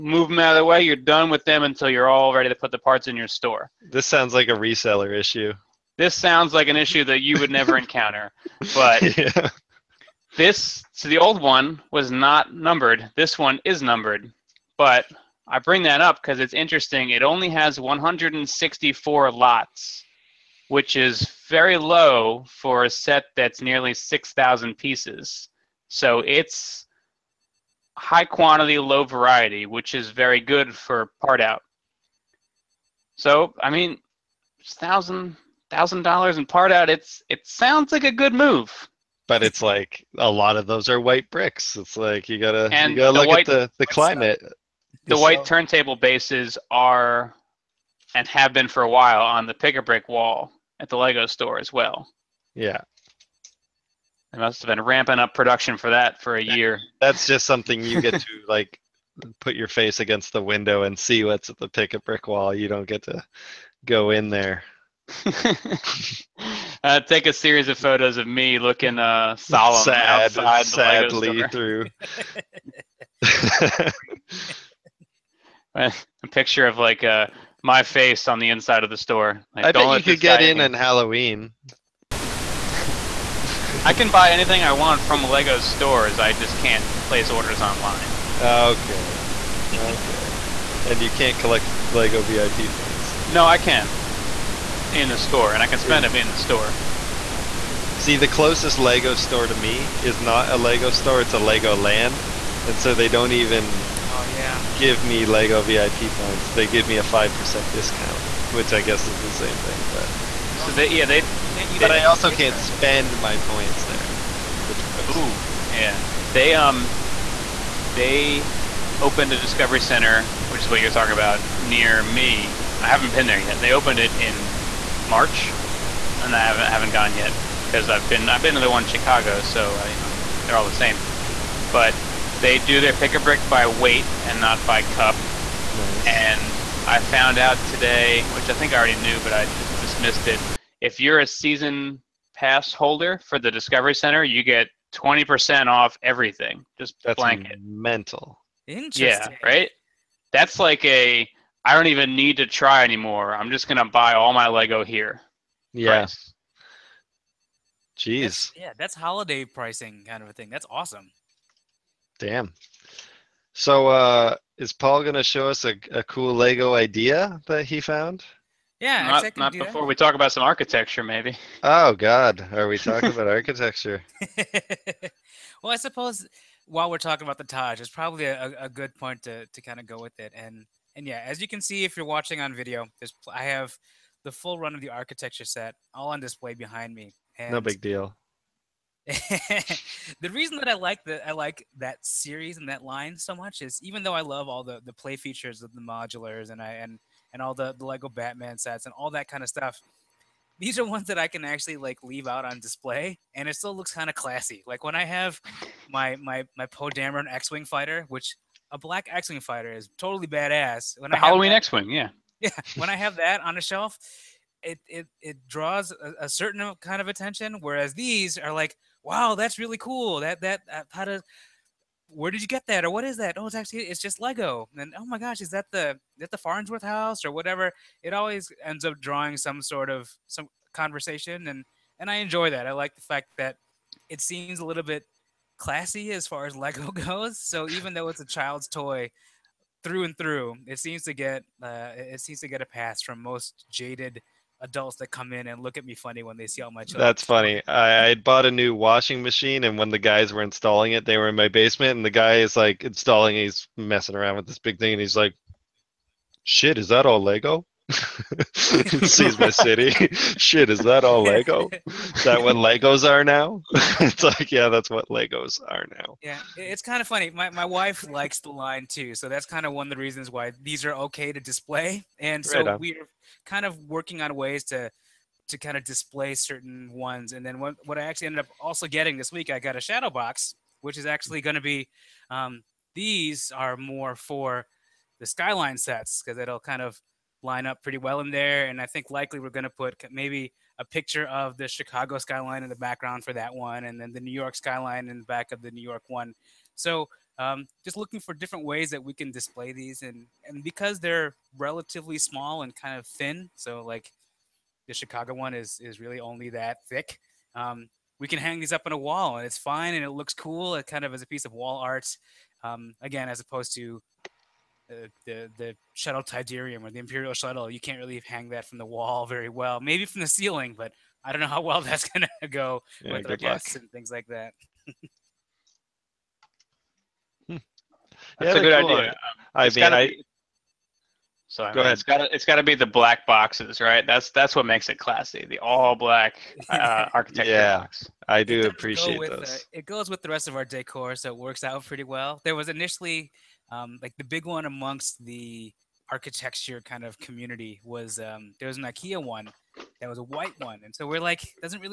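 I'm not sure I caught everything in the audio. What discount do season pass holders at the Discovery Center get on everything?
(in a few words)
20%.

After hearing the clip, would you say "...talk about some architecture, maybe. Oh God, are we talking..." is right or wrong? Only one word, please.
right.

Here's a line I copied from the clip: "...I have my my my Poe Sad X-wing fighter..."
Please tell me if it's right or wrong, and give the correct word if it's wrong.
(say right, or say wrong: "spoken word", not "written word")
wrong: "Dameron", not "Sad".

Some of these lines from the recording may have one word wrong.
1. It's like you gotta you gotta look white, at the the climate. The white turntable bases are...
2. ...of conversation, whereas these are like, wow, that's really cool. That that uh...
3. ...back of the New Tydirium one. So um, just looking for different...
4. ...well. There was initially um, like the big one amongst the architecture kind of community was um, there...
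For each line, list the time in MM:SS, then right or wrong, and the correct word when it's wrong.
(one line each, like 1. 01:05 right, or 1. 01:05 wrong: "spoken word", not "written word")
1. 00:41 right
2. 03:37 wrong: "attention", not "conversation"
3. 04:55 wrong: "York", not "Tydirium"
4. 05:42 right.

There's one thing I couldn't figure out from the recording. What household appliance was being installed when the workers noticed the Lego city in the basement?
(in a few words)
washing machine.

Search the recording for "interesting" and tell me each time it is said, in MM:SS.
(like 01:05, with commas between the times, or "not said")
00:16, 02:28.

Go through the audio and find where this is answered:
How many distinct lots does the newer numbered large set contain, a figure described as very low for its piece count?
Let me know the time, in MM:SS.
00:17.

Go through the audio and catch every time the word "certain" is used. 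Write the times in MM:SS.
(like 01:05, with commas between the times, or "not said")
03:36, 04:36.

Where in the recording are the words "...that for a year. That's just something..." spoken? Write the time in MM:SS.
00:55.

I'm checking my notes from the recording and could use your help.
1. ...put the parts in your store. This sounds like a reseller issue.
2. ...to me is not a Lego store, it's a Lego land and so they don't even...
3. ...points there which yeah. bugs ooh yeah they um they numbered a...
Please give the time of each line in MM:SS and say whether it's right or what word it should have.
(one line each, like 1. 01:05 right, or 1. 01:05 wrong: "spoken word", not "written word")
1. 00:02 right
2. 01:39 right
3. 01:53 wrong: "opened", not "numbered".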